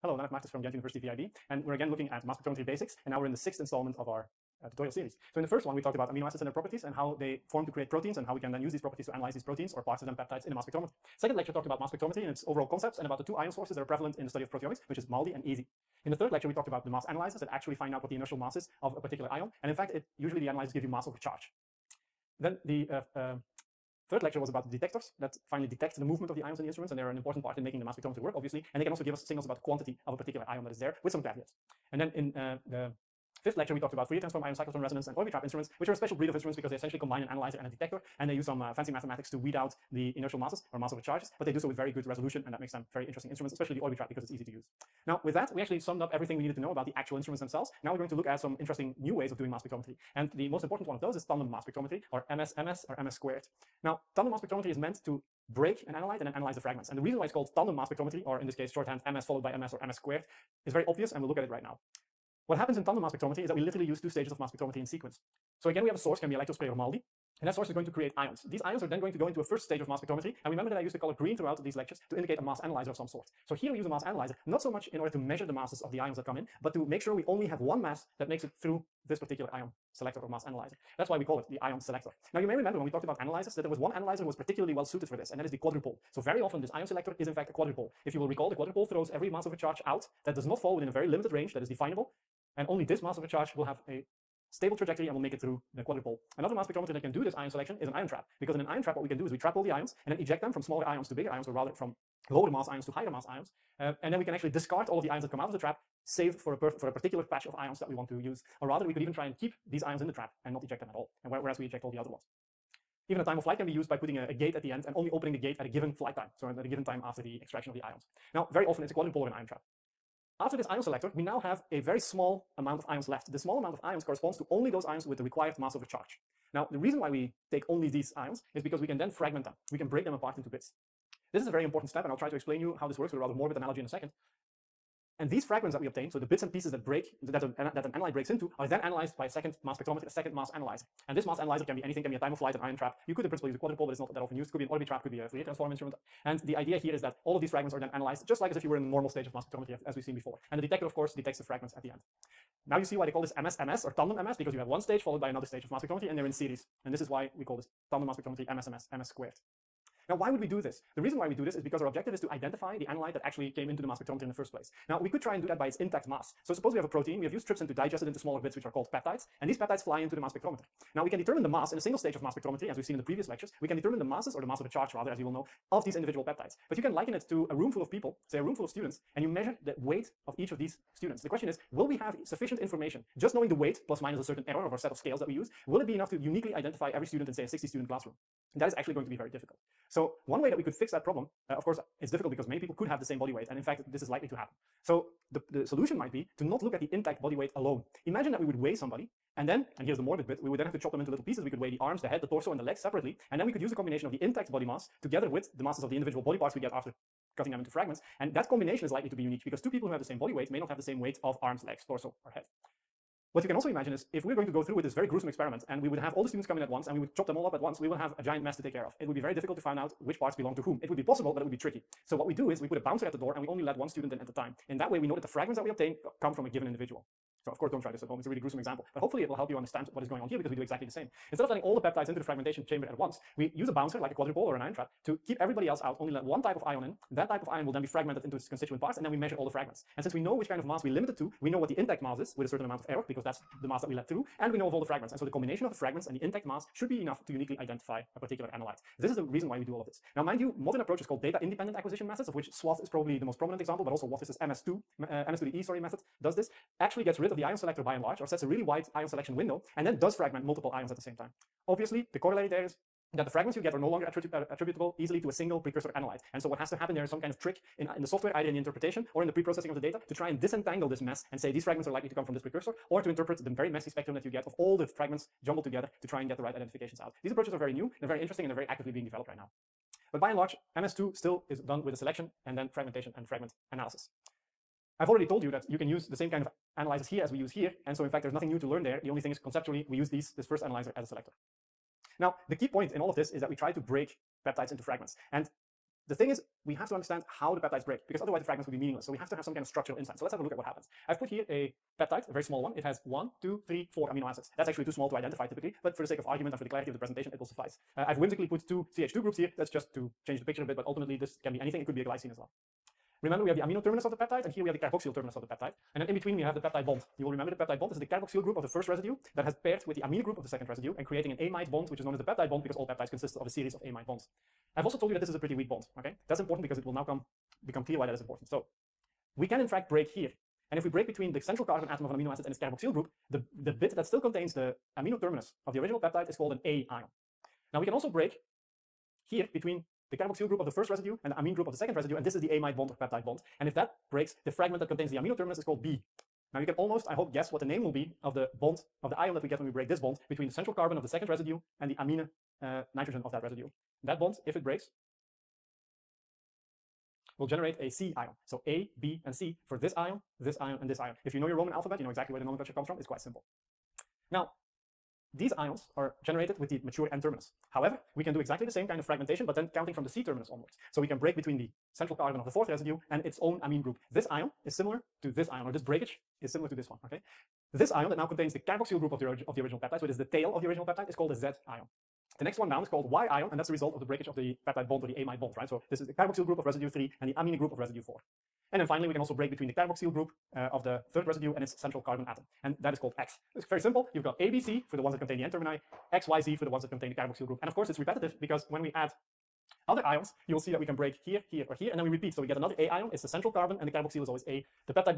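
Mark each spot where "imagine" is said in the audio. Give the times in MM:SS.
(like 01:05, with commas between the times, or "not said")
03:18, 03:33.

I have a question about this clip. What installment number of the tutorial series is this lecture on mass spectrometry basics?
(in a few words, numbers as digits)
6th.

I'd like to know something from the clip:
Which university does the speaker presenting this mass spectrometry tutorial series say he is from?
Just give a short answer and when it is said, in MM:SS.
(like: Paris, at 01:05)
Ghent University, at 00:00.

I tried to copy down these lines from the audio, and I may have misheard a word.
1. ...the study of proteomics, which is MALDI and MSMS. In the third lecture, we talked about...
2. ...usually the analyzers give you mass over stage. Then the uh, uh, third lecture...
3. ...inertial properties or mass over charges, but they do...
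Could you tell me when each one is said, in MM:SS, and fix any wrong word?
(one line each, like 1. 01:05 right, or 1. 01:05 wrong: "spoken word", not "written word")
1. 00:14 wrong: "ESI", not "MSMS"
2. 00:20 wrong: "charge", not "stage"
3. 00:40 wrong: "masses", not "properties".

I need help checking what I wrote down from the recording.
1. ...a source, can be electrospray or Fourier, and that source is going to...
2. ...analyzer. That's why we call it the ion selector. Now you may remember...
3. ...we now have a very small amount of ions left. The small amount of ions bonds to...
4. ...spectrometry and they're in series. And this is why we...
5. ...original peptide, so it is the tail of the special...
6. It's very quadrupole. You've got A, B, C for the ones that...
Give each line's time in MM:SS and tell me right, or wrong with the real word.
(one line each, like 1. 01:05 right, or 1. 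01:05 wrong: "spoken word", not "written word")
1. 01:05 wrong: "MALDI", not "Fourier"
2. 01:20 right
3. 02:01 wrong: "corresponds", not "bonds"
4. 02:35 right
5. 06:19 wrong: "original", not "special"
6. 06:33 wrong: "simple", not "quadrupole".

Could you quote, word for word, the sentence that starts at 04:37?
These approaches are very new, they're very interesting, and they're very actively being developed right now.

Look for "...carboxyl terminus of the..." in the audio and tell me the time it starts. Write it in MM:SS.
05:14.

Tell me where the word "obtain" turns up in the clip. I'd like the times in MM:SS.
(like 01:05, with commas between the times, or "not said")
02:15, 03:45.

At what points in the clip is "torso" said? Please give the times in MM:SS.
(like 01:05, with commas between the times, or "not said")
03:22, 03:31.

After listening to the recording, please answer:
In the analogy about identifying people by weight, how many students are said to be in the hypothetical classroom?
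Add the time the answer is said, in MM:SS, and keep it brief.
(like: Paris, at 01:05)
60, at 03:07.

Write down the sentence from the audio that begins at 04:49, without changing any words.
The only thing is conceptually, we use these, this first analyzer as a selector.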